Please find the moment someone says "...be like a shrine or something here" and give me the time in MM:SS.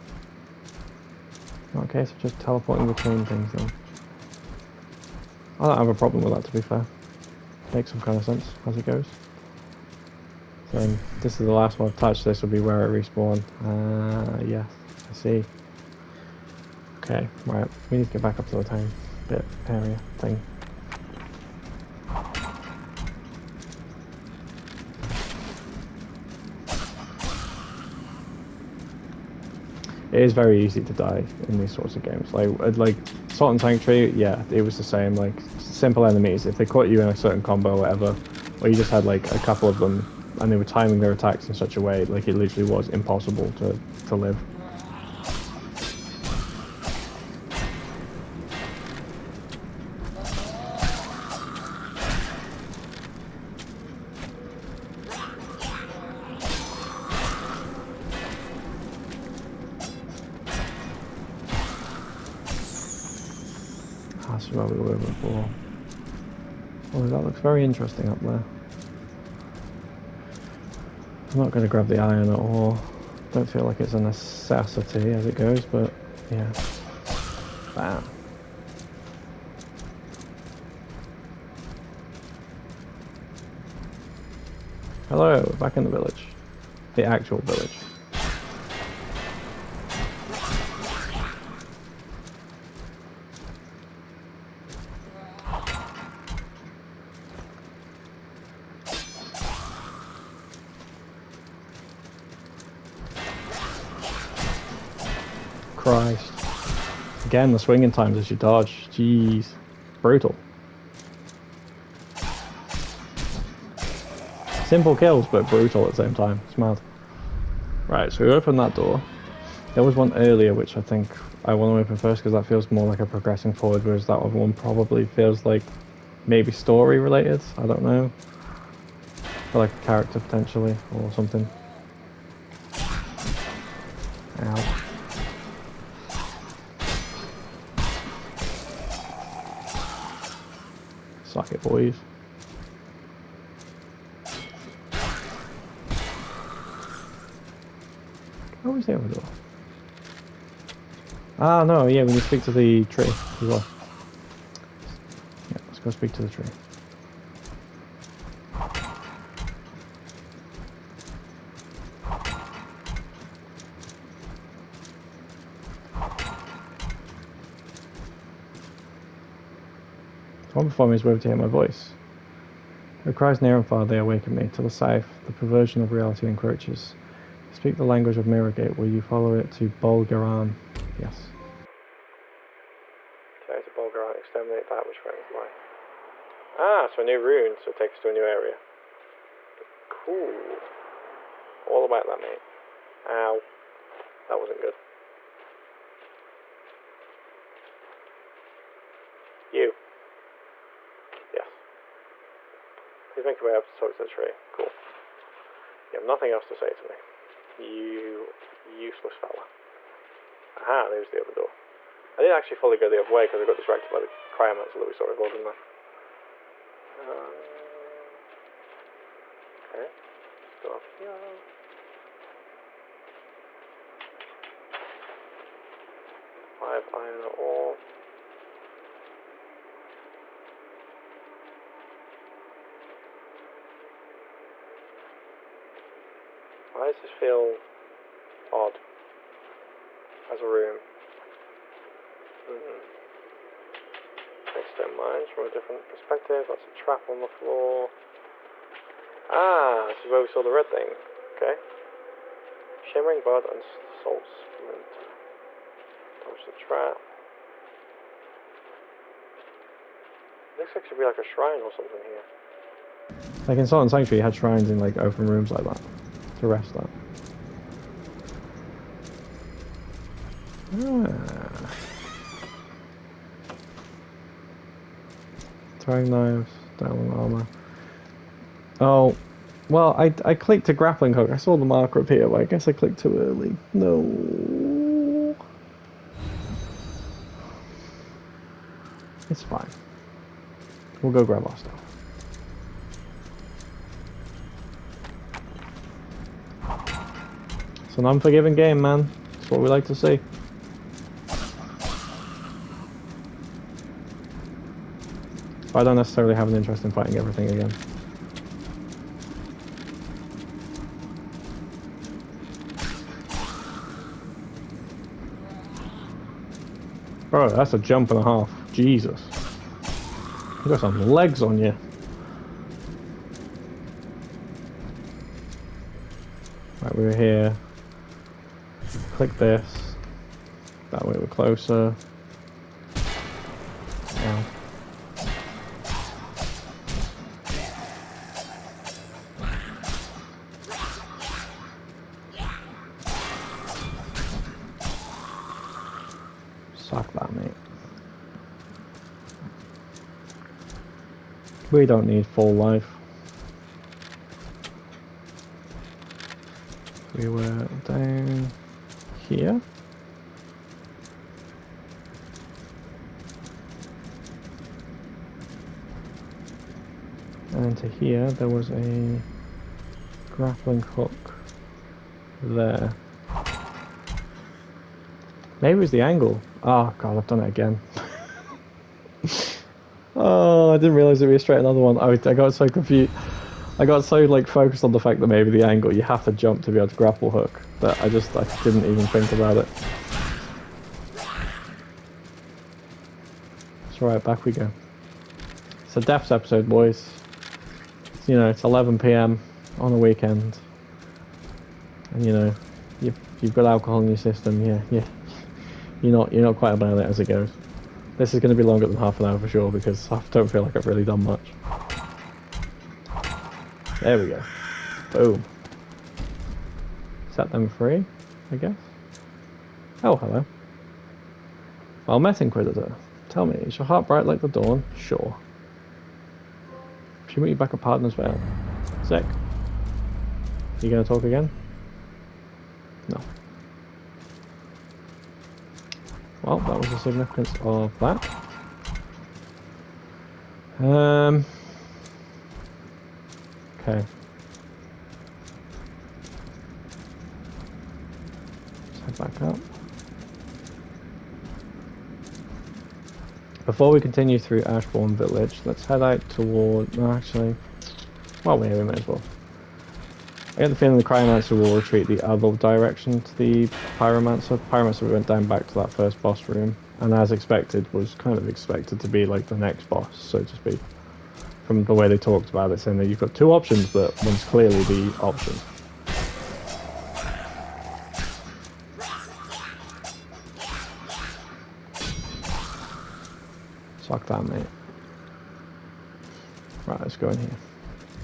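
04:20.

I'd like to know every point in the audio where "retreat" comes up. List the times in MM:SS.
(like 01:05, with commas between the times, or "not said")
07:41.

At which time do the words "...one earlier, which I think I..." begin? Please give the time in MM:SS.
01:59.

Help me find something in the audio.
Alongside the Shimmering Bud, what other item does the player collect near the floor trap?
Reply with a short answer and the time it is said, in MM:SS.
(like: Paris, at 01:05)
Salt Splinter, at 04:13.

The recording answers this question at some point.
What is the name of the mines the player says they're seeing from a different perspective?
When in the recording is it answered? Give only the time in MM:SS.
04:04.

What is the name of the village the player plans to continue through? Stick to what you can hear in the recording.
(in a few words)
Ashbourne Village.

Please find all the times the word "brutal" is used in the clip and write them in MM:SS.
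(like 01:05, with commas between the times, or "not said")
01:50, 01:55.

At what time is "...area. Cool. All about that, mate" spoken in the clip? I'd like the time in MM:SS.
03:08.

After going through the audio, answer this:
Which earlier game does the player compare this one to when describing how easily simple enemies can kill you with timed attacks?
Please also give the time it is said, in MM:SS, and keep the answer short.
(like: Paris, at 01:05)
Salt and Sanctuary, at 00:33.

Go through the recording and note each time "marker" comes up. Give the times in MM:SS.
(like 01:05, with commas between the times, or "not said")
04:41.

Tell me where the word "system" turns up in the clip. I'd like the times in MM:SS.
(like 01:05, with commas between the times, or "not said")
06:44.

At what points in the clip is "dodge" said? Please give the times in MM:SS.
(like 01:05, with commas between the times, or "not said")
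01:48, 04:16.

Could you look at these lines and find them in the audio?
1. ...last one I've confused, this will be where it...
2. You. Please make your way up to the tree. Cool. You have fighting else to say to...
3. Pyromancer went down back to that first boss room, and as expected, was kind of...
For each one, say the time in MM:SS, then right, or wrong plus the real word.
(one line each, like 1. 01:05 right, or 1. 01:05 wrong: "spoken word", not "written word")
1. 00:11 wrong: "touched", not "confused"
2. 03:19 wrong: "nothing", not "fighting"
3. 07:44 right.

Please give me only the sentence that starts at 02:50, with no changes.
One is wherever to hear my voice.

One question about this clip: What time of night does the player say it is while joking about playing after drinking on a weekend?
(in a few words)
11 p.m.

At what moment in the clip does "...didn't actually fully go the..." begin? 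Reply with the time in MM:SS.
03:32.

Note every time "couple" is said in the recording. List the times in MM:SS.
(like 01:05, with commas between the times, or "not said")
00:39.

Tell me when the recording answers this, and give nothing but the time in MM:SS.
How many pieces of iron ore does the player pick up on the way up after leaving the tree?
03:46.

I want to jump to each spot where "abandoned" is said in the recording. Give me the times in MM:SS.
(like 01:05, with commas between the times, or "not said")
not said.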